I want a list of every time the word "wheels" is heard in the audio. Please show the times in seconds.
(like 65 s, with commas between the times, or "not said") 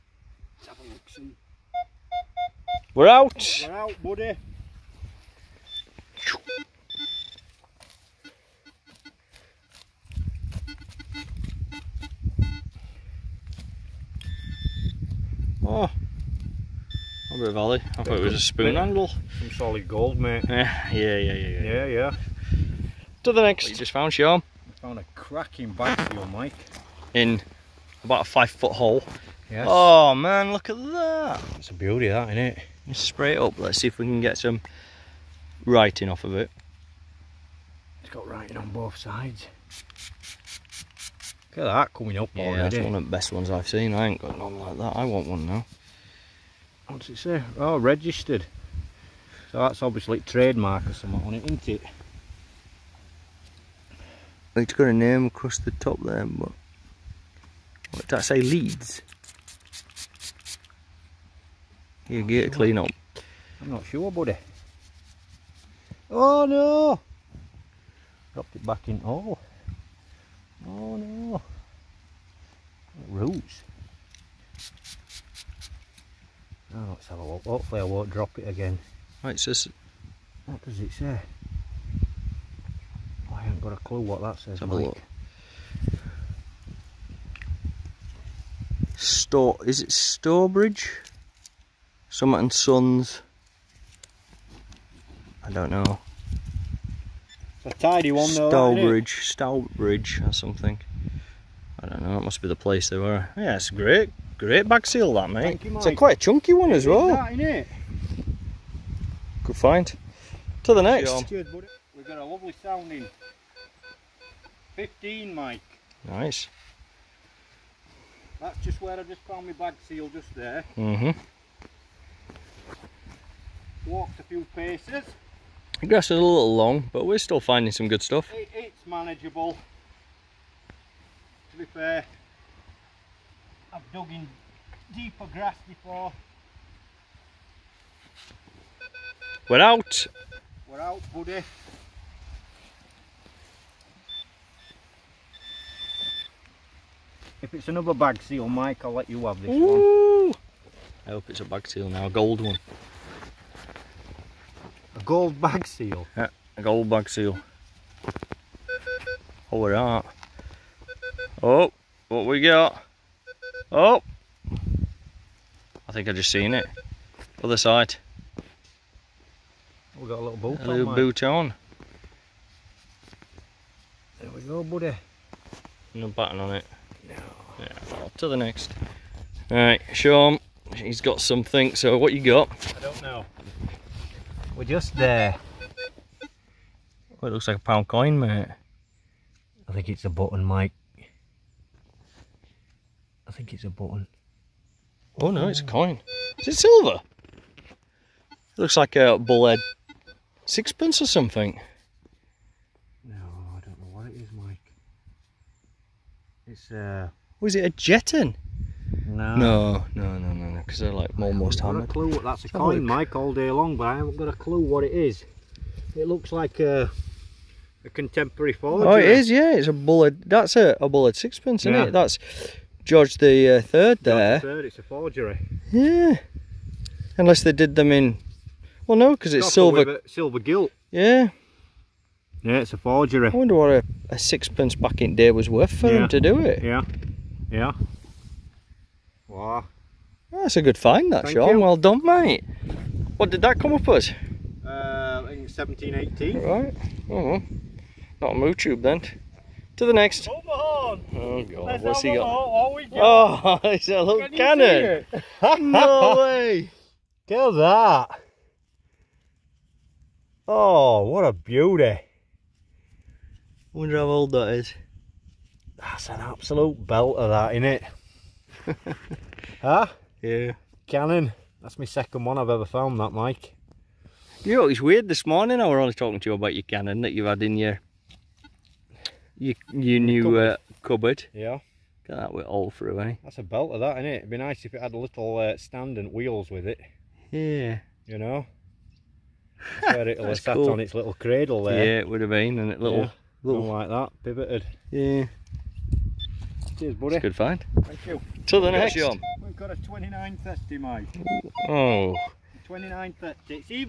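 286 s.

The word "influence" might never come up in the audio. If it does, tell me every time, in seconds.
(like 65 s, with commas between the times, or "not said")
not said.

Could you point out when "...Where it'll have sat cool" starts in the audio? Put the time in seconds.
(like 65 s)
289 s.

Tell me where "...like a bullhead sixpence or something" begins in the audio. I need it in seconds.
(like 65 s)
198 s.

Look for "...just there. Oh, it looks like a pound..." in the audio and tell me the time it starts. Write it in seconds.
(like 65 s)
184 s.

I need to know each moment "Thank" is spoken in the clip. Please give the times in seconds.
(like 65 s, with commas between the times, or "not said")
241 s, 297 s.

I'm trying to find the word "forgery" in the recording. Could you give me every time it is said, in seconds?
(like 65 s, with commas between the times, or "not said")
218 s, 224 s, 232 s.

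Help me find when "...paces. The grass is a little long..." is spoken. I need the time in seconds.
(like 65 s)
124 s.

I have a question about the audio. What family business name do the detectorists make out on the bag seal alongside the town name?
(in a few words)
Summit and Sons.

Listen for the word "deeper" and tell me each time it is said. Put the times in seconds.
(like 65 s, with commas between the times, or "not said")
134 s.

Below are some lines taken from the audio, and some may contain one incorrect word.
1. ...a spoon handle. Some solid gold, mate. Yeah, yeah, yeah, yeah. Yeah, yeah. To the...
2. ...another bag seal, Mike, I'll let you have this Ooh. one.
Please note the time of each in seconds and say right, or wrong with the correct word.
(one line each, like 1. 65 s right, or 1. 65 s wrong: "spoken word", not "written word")
1. 18 s right
2. 147 s right.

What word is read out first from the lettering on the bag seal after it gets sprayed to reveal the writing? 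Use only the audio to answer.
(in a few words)
Registered.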